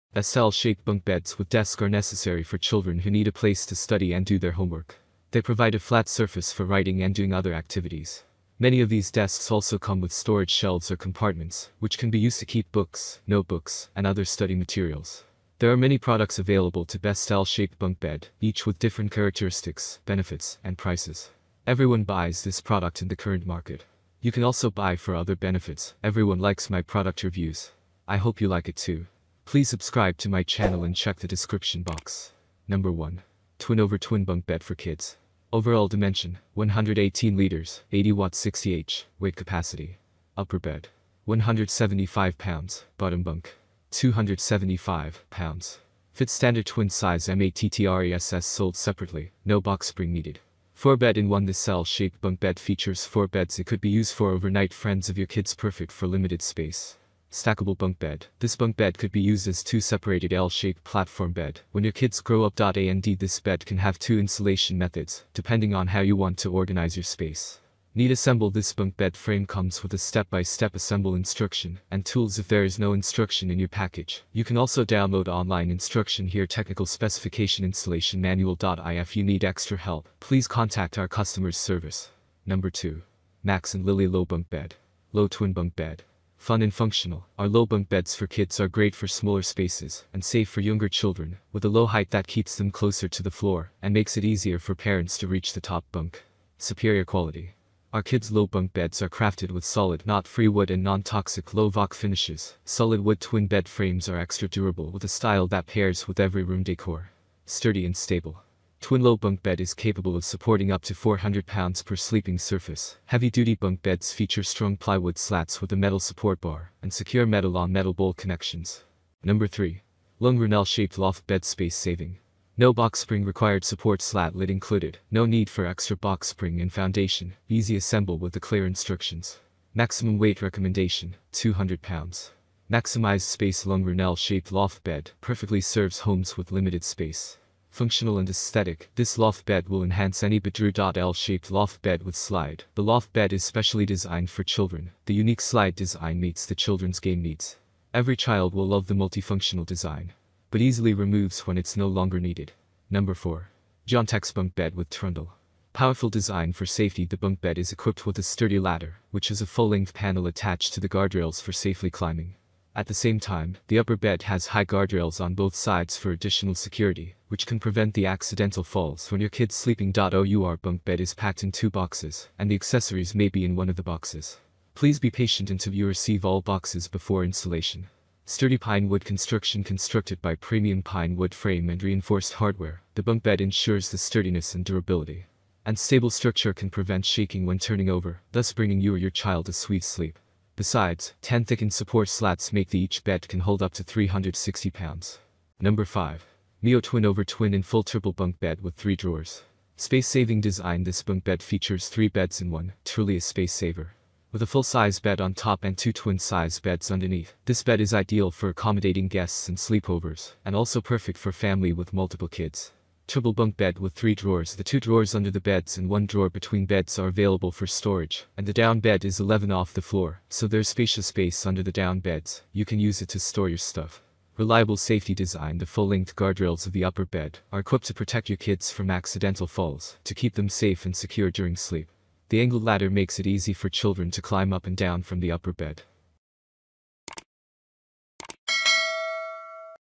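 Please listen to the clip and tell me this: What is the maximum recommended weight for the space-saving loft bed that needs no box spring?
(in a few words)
200 pounds.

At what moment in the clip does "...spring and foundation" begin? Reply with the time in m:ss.
2:06.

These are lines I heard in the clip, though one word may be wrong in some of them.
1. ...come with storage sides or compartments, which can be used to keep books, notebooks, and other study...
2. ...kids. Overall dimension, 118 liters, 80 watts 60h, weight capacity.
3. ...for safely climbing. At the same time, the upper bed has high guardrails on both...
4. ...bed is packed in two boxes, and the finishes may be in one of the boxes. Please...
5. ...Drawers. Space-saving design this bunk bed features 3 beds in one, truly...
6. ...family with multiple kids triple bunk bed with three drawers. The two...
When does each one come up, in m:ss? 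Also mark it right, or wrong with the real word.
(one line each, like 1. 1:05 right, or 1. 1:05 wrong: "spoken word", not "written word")
1. 0:09 wrong: "shelves", not "sides"
2. 0:34 right
3. 2:41 right
4. 2:50 wrong: "accessories", not "finishes"
5. 3:18 right
6. 3:31 right.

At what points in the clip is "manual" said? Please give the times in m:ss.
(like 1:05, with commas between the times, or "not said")
1:18.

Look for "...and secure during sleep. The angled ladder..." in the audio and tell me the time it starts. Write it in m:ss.
3:50.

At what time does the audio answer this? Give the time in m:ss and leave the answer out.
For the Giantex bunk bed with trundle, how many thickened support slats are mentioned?
3:11.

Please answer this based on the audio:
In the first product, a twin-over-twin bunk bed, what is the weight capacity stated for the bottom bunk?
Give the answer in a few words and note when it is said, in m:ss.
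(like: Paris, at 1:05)
275 pounds, at 0:43.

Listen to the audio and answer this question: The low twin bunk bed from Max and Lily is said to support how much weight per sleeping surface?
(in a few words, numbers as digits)
400 pounds.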